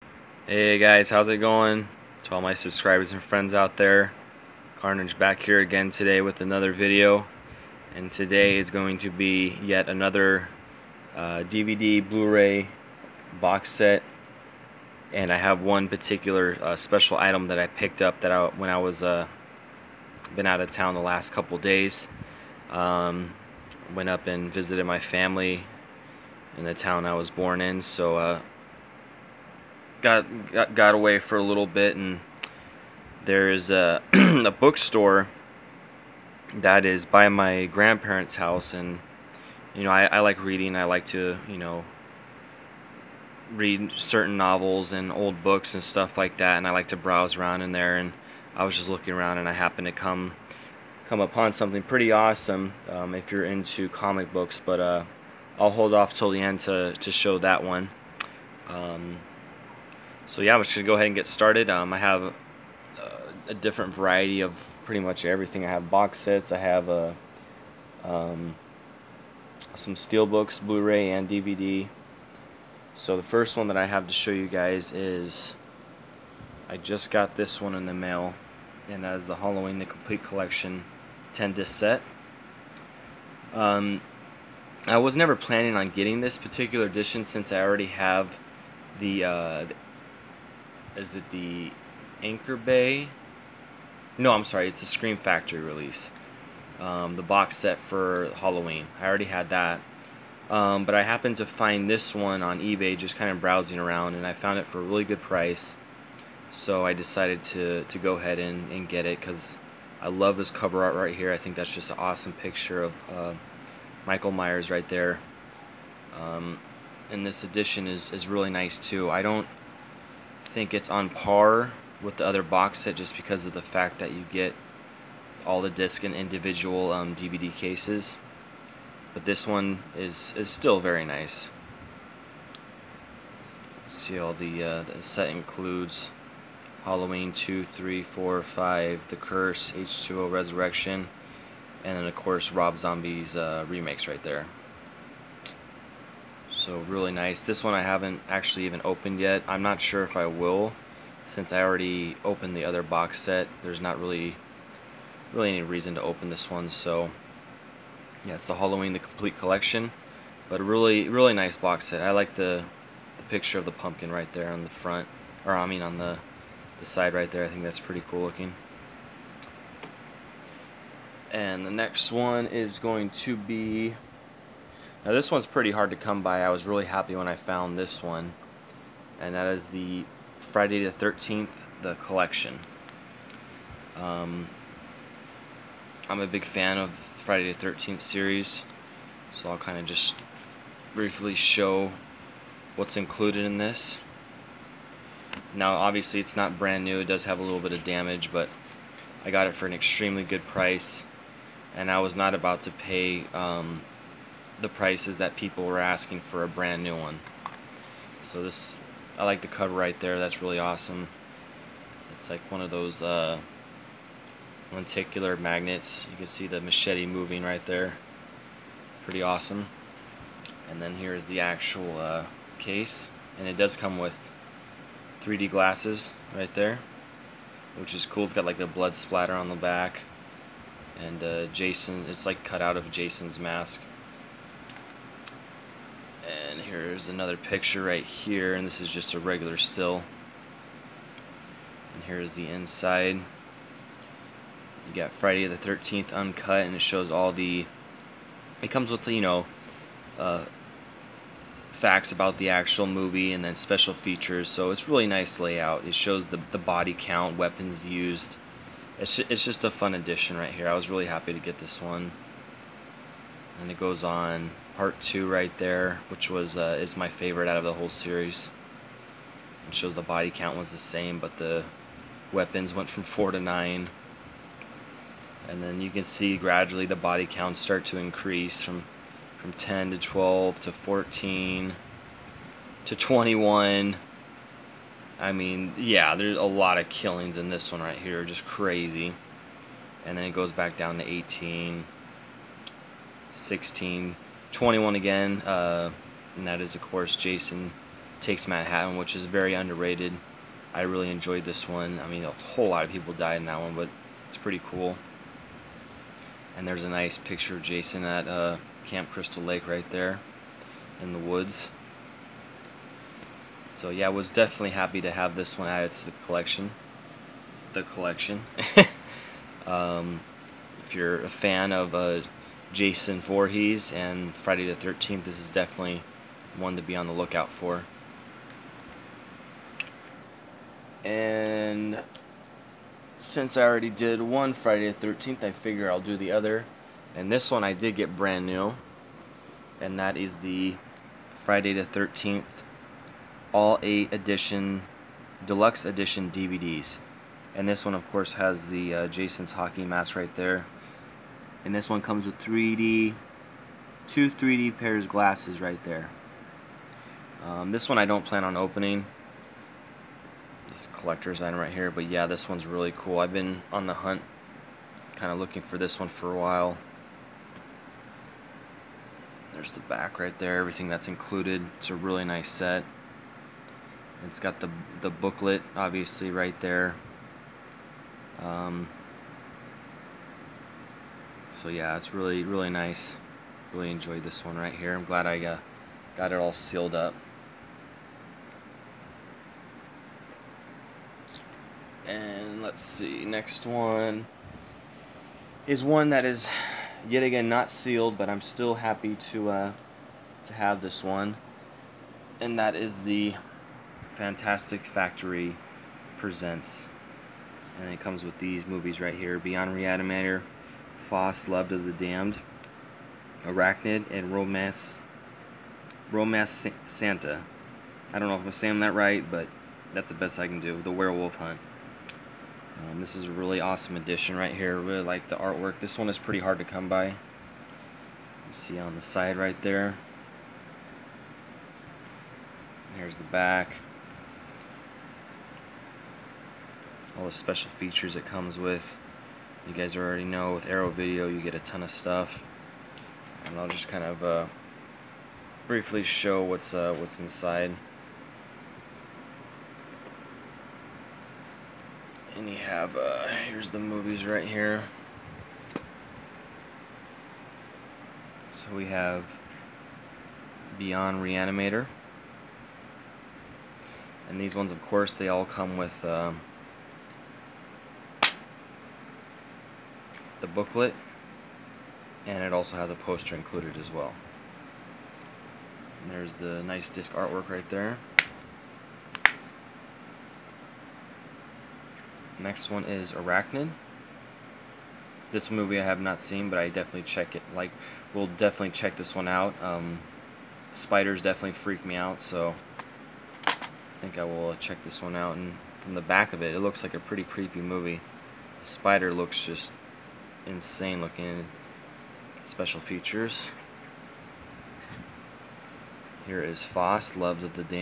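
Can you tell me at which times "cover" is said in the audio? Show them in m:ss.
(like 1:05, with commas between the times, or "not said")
1:50, 3:29.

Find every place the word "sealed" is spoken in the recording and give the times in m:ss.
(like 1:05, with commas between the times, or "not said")
6:26, 6:37.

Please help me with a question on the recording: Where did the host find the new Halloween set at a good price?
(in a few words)
eBay.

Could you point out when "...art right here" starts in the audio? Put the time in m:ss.
1:50.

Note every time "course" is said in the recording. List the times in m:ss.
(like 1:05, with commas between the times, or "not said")
2:22, 4:56, 5:48, 7:44.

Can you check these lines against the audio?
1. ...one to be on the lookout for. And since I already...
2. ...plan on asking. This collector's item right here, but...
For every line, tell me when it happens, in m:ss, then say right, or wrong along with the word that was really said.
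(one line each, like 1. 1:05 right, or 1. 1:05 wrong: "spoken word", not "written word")
1. 5:26 right
2. 5:58 wrong: "opening", not "asking".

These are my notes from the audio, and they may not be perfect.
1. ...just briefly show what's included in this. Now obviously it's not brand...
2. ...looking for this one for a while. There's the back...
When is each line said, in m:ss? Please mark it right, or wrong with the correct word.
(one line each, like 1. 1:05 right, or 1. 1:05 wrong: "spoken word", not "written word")
1. 3:09 right
2. 6:05 right.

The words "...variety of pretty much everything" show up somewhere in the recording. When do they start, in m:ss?
1:03.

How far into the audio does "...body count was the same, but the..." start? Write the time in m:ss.
4:30.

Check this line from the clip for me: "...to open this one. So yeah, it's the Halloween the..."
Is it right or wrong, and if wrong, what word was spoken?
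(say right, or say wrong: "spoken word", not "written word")
right.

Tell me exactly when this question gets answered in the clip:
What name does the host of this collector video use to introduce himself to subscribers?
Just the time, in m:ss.
0:04.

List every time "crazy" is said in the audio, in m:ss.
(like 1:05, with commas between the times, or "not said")
4:48.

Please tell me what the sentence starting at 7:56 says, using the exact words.
And there's the nice disc artwork right there.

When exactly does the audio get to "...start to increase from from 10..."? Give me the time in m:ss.
4:37.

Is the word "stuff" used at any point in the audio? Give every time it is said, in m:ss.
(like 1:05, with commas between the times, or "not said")
0:45, 7:21.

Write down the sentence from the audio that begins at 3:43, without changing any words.
And it does come with 3D glasses right there, which is cool.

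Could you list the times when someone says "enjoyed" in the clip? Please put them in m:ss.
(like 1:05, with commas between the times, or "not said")
5:01, 6:23.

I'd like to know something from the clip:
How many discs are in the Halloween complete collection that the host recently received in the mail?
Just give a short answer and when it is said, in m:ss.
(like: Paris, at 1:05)
10, at 1:21.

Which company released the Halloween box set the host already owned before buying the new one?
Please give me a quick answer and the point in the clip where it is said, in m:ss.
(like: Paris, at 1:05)
Scream Factory, at 1:34.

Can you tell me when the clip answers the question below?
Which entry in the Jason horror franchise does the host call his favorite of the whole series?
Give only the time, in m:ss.
4:24.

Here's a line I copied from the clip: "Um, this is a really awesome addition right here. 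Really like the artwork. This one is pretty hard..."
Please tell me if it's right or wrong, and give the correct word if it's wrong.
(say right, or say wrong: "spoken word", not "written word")
wrong: "edition", not "addition".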